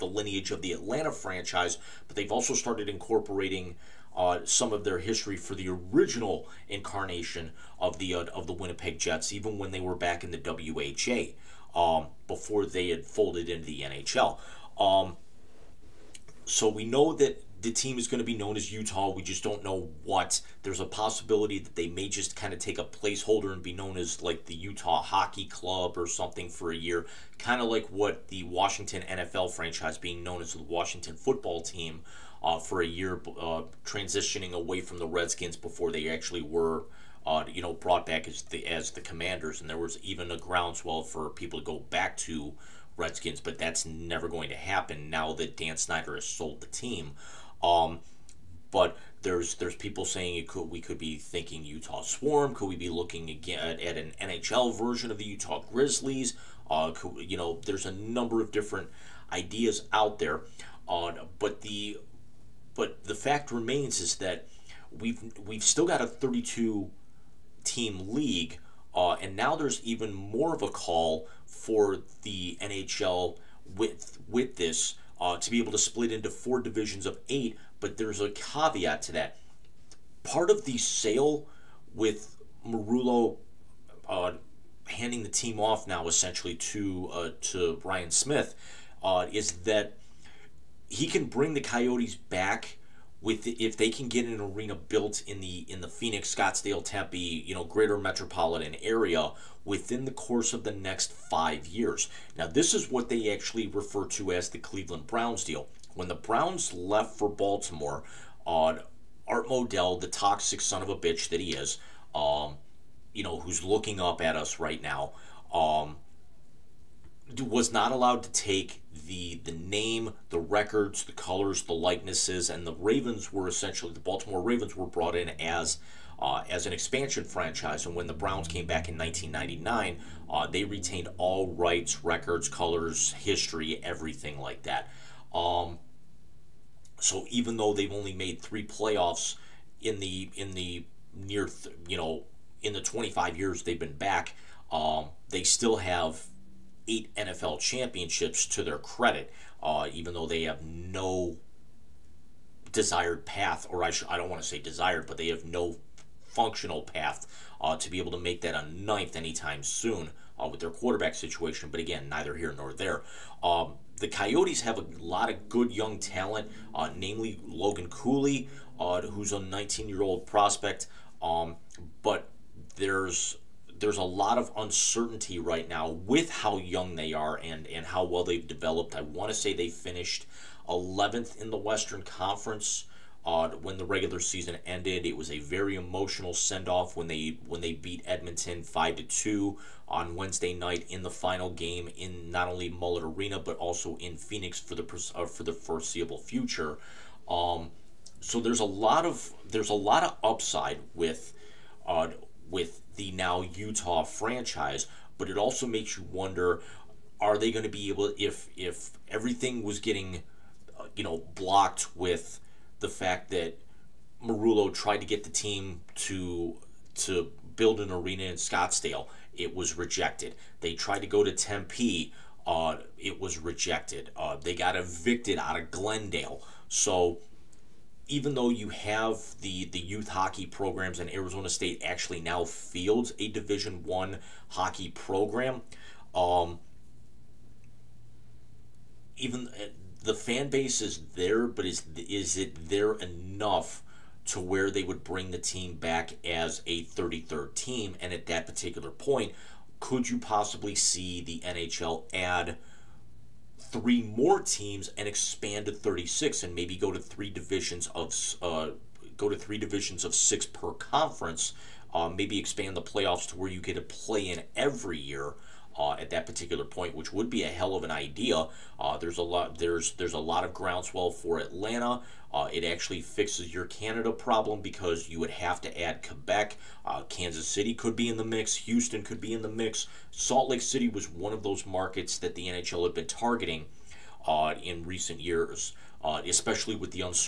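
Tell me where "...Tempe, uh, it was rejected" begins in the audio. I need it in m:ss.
3:41.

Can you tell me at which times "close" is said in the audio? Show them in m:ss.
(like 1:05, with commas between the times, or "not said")
not said.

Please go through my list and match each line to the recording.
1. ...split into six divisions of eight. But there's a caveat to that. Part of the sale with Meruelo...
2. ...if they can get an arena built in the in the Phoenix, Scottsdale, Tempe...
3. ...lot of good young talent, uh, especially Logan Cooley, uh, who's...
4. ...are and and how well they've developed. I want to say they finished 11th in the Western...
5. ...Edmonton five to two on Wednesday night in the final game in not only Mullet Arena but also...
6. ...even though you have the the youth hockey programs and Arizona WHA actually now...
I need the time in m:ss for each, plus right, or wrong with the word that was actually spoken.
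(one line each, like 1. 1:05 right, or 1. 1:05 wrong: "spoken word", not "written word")
1. 1:15 wrong: "four", not "six"
2. 1:33 right
3. 2:44 wrong: "namely", not "especially"
4. 2:57 right
5. 3:08 right
6. 3:48 wrong: "State", not "WHA".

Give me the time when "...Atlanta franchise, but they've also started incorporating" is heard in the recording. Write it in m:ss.
0:00.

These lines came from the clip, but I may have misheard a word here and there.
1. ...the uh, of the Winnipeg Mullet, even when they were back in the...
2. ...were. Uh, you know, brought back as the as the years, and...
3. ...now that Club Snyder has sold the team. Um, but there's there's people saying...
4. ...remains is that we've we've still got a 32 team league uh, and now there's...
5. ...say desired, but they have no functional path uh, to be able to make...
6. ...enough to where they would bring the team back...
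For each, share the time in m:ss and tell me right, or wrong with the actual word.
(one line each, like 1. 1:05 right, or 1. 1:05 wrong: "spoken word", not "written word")
1. 0:07 wrong: "Jets", not "Mullet"
2. 0:36 wrong: "commanders", not "years"
3. 0:45 wrong: "Dan", not "Club"
4. 1:03 right
5. 2:34 right
6. 4:02 right.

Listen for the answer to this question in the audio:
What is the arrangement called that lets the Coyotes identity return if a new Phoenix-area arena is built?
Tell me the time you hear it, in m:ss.
1:44.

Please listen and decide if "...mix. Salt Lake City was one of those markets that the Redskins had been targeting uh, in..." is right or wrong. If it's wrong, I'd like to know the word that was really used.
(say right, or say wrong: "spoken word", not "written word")
wrong: "NHL", not "Redskins".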